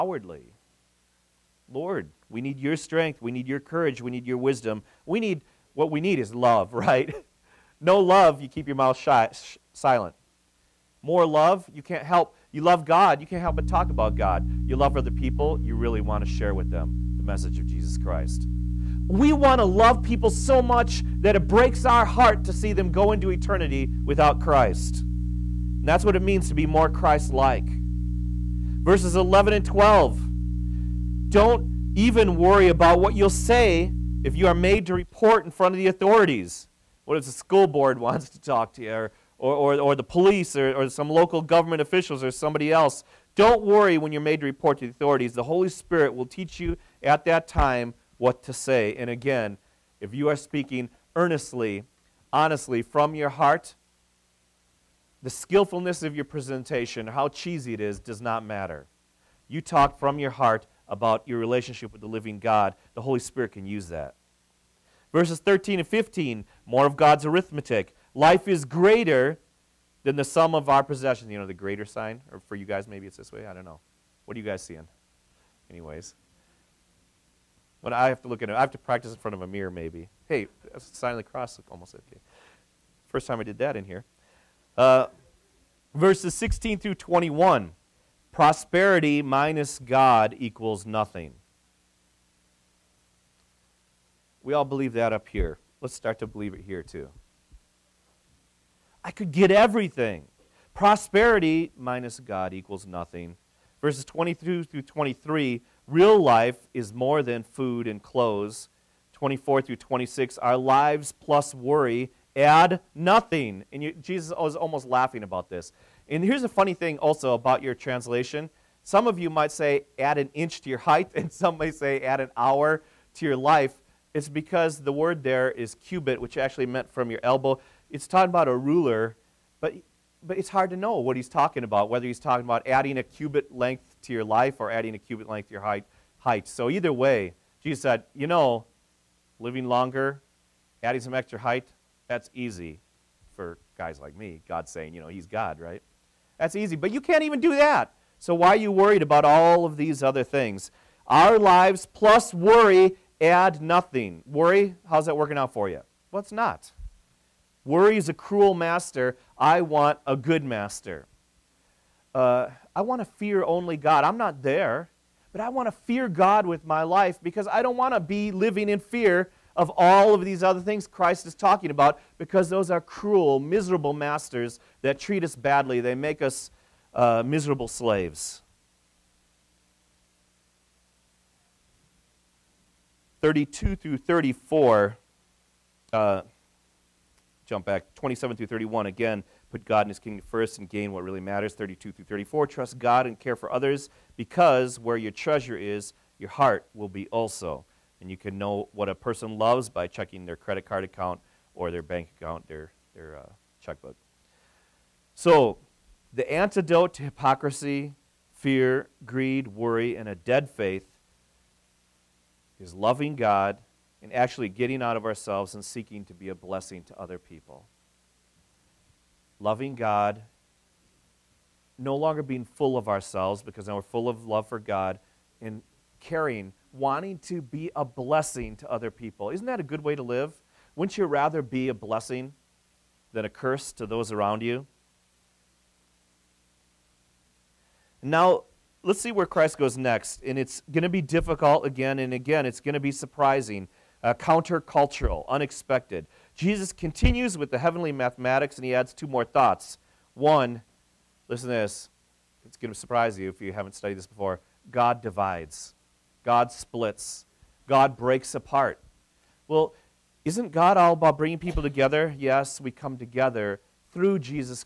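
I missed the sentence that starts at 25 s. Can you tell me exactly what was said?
And that's what it means to be more Christ like.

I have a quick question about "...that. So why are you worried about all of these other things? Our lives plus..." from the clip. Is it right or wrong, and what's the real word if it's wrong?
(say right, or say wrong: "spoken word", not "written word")
right.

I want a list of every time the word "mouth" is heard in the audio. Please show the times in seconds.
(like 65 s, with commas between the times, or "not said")
8 s.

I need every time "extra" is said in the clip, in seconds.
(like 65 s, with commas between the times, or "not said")
141 s.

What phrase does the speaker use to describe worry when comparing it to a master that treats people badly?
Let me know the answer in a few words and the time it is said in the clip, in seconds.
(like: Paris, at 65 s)
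a cruel master, at 158 s.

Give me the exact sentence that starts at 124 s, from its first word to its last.
It's because the word there is cubit, which actually meant from your elbow.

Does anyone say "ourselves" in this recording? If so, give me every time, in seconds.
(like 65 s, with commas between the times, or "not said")
215 s, 222 s.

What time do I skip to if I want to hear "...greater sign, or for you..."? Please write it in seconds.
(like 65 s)
71 s.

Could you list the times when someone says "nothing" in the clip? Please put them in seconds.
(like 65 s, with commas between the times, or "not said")
90 s, 102 s, 112 s, 153 s.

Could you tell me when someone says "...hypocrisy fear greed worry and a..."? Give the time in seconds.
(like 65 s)
207 s.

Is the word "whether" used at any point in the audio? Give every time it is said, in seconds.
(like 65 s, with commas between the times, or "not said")
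131 s.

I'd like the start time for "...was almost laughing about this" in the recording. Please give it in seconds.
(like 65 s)
114 s.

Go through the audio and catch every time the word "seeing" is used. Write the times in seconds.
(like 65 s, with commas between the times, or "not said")
74 s.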